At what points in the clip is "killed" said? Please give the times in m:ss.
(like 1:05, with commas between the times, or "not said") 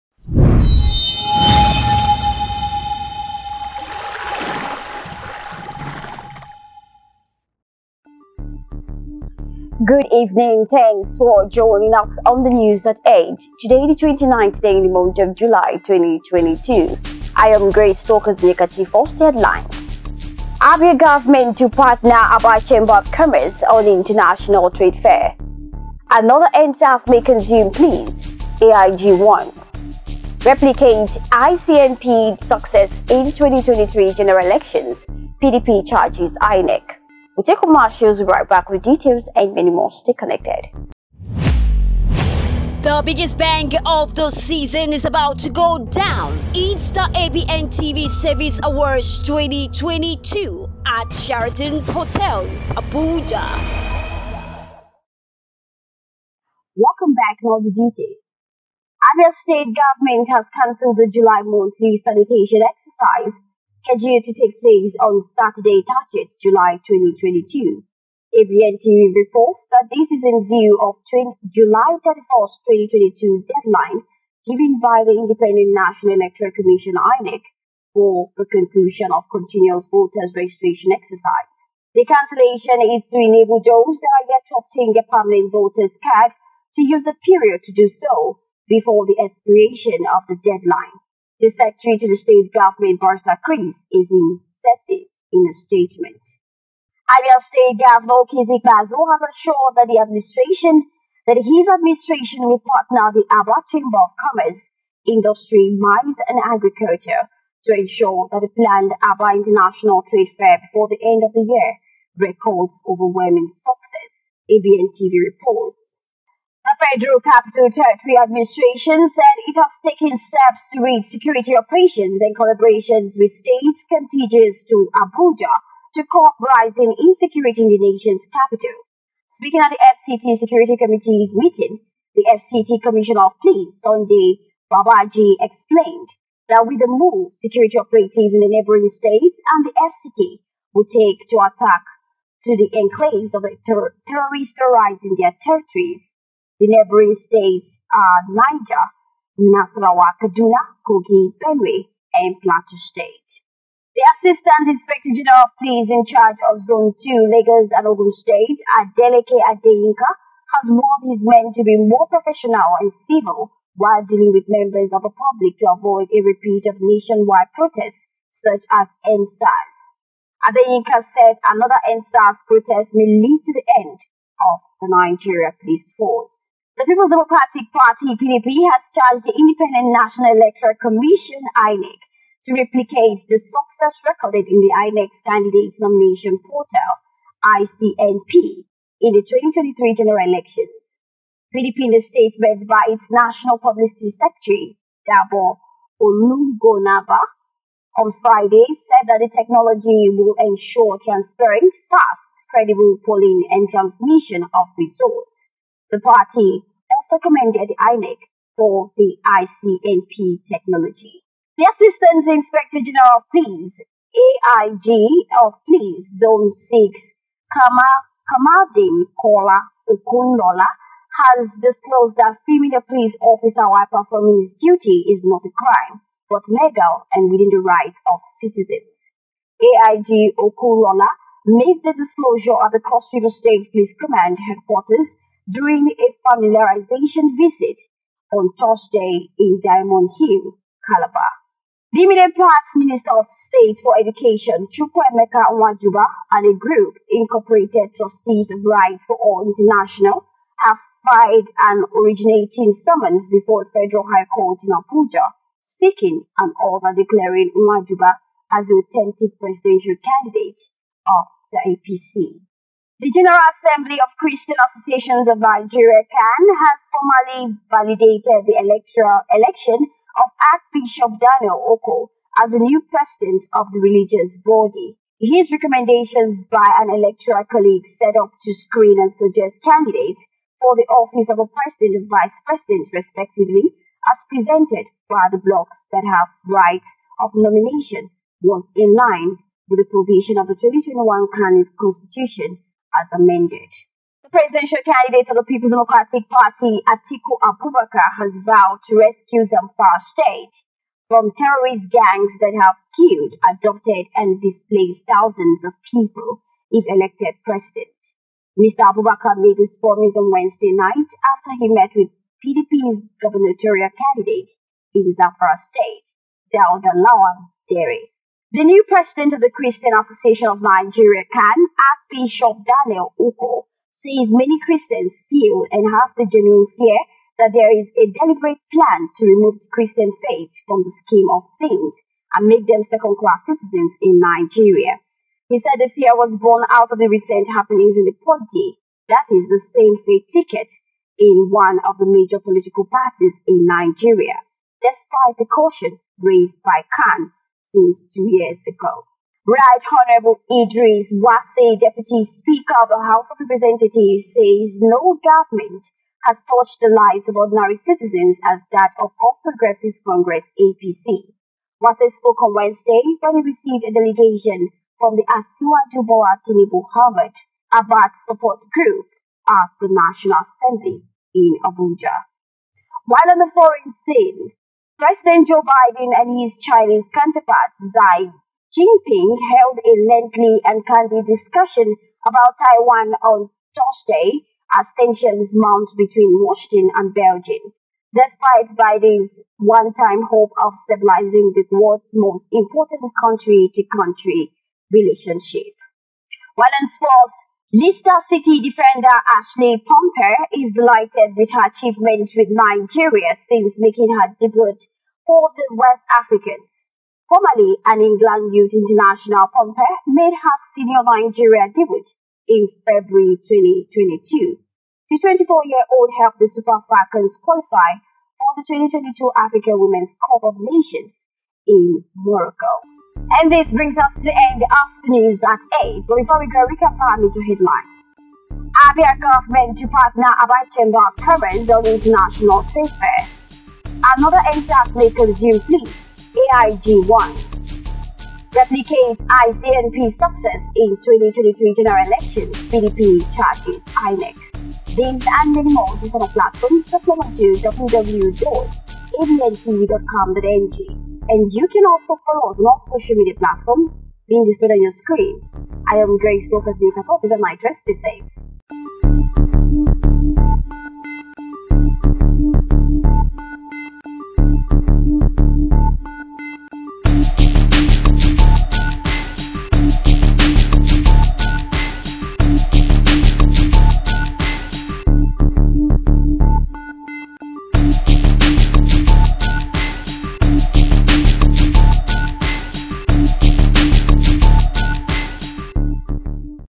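5:02.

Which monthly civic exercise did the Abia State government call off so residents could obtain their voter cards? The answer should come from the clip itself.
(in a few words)
Monthly sanitation exercise.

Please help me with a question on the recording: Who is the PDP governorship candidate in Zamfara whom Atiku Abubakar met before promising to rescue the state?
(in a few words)
Daud Lawal Dare.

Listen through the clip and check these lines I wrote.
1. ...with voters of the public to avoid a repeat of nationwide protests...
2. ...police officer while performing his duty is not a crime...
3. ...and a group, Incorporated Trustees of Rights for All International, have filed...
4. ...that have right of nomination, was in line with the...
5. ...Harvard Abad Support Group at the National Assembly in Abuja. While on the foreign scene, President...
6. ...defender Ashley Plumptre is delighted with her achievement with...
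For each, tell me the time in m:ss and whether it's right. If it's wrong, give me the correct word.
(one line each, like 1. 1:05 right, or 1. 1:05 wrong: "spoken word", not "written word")
1. 2:44 wrong: "members", not "voters"
2. 3:42 right
3. 4:06 right
4. 4:45 right
5. 6:06 right
6. 6:38 right.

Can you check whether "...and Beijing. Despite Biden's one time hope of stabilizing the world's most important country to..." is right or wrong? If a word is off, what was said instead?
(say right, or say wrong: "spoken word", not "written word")
right.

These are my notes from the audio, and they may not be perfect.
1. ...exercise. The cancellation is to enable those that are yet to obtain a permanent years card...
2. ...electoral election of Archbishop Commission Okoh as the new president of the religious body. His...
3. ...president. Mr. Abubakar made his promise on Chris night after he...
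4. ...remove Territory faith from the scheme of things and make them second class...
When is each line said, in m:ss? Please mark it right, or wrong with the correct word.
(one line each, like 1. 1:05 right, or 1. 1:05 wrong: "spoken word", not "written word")
1. 1:20 wrong: "voters", not "years"
2. 4:28 wrong: "Daniel", not "Commission"
3. 5:07 wrong: "Wednesday", not "Chris"
4. 5:29 wrong: "Christian", not "Territory".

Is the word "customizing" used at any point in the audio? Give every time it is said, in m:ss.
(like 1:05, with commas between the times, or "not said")
not said.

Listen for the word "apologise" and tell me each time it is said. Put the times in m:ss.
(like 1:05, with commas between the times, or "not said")
not said.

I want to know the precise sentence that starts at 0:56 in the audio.
Welcome back to all the details.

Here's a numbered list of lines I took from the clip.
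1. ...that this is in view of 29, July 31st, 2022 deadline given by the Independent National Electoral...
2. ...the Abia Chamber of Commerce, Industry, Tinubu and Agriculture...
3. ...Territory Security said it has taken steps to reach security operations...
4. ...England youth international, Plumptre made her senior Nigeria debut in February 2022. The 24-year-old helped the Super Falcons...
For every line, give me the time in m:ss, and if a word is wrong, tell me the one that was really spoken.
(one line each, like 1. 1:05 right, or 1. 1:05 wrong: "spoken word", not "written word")
1. 1:09 wrong: "20", not "29"
2. 1:43 wrong: "Mines", not "Tinubu"
3. 1:57 wrong: "Administration", not "Security"
4. 6:48 right.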